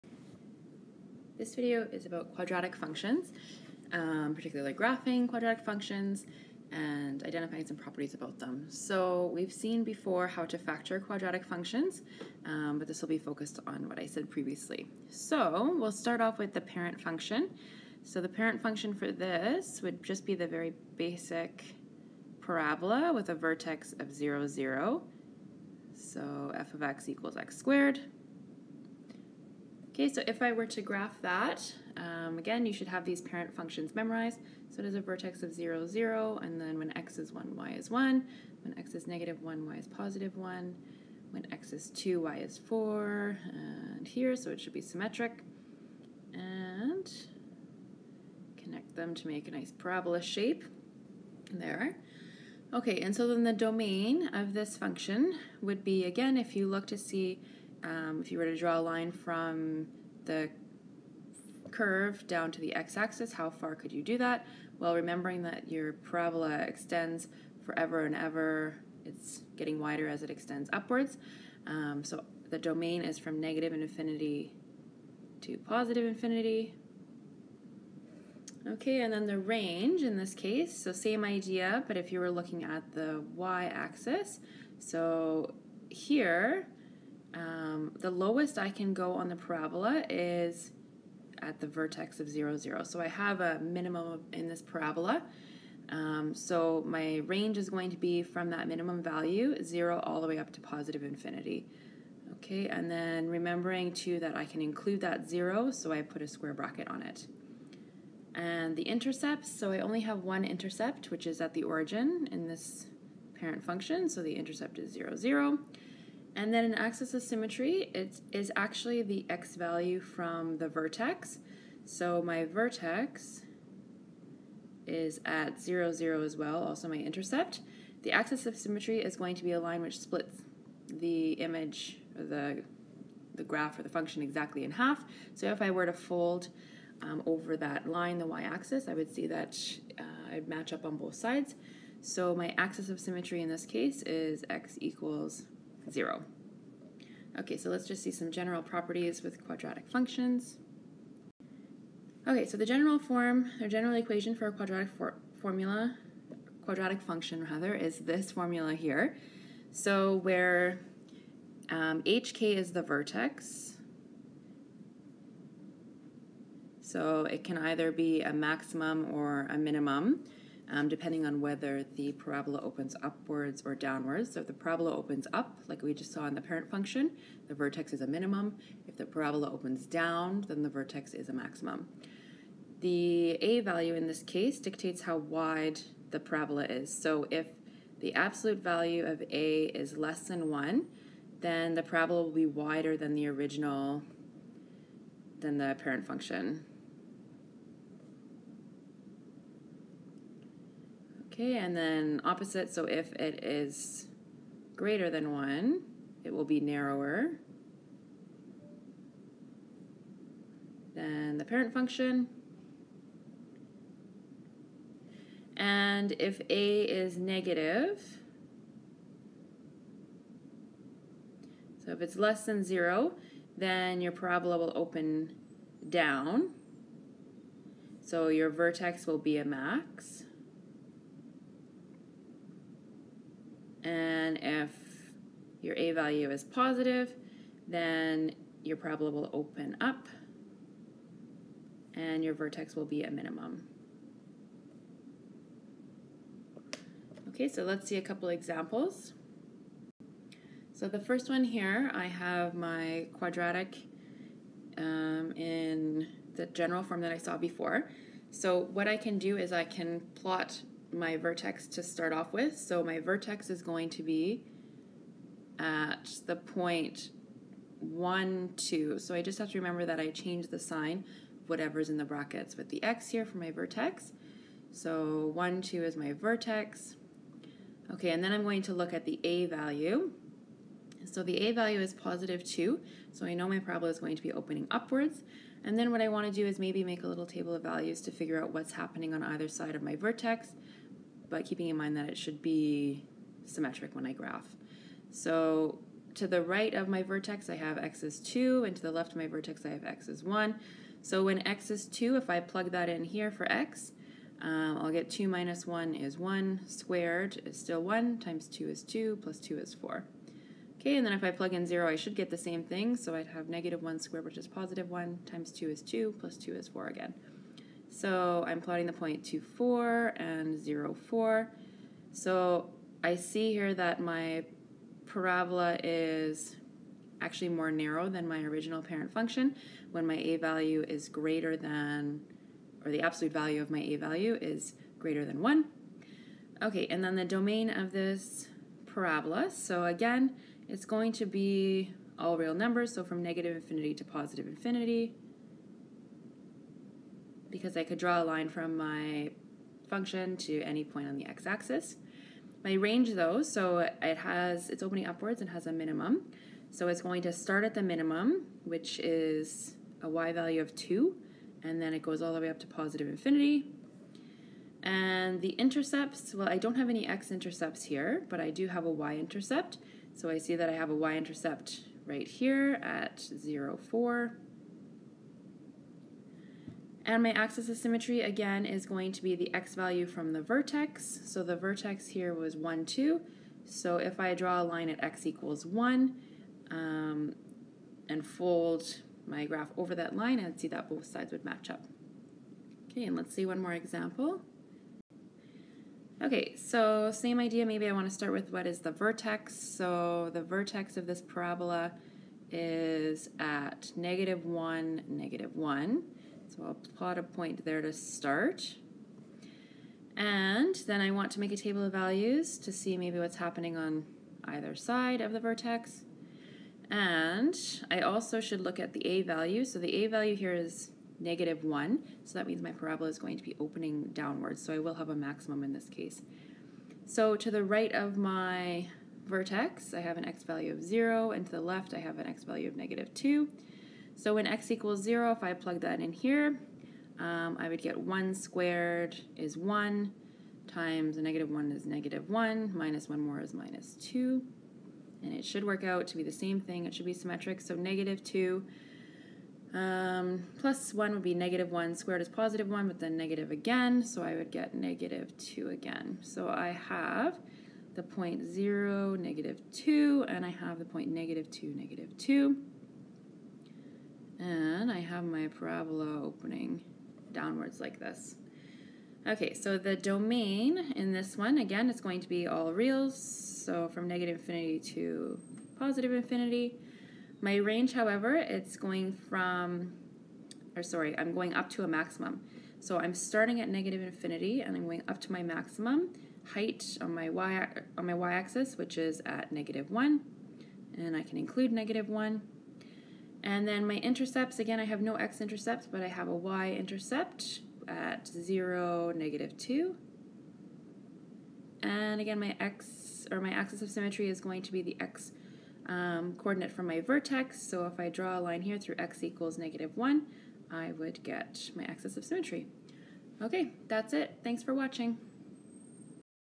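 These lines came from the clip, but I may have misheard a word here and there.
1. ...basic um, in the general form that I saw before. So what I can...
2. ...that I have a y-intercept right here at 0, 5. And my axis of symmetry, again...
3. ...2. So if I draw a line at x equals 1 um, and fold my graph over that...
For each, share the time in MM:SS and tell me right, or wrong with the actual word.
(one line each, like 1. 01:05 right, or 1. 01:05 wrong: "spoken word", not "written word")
1. 04:13 wrong: "quadratic", not "basic"
2. 06:10 wrong: "4", not "5"
3. 06:22 right.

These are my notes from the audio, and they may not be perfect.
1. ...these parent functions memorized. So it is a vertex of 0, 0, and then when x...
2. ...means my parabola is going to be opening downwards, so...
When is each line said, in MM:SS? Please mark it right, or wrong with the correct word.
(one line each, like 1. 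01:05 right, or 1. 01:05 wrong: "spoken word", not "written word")
1. 00:33 right
2. 07:02 right.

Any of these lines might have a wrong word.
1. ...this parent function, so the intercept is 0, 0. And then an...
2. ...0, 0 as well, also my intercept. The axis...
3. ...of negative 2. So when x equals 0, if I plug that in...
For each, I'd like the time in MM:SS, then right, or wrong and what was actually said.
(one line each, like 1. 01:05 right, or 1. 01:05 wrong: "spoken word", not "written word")
1. 01:52 right
2. 02:05 right
3. 07:12 right.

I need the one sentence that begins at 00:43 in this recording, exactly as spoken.
And here, so it should be symmetric.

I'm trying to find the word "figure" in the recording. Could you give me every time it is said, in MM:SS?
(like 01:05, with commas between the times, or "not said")
04:48.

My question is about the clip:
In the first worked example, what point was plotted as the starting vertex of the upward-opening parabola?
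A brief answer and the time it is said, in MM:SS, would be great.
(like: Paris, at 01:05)
(1, 2), at 04:35.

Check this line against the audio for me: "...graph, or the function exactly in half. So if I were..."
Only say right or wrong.
right.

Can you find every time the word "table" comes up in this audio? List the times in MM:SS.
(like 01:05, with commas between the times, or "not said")
04:47, 06:51.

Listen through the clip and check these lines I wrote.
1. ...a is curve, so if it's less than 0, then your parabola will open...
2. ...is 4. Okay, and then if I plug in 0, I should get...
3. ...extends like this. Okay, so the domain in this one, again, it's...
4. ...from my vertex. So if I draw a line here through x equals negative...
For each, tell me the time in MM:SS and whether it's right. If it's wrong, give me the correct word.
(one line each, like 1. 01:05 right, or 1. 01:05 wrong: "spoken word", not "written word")
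1. 03:36 wrong: "negative", not "curve"
2. 05:09 right
3. 07:47 wrong: "downwards", not "extends"
4. 08:26 right.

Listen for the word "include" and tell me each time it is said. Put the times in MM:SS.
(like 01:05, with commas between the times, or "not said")
01:44, 08:11.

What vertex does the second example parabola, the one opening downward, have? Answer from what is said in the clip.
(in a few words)
(-1, -1).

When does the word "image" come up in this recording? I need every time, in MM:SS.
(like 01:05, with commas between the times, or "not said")
02:11.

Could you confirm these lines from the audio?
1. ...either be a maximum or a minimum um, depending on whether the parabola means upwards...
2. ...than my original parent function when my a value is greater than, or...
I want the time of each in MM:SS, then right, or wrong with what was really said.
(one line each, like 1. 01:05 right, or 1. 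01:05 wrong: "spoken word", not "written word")
1. 02:47 wrong: "opens", not "means"
2. 05:28 right.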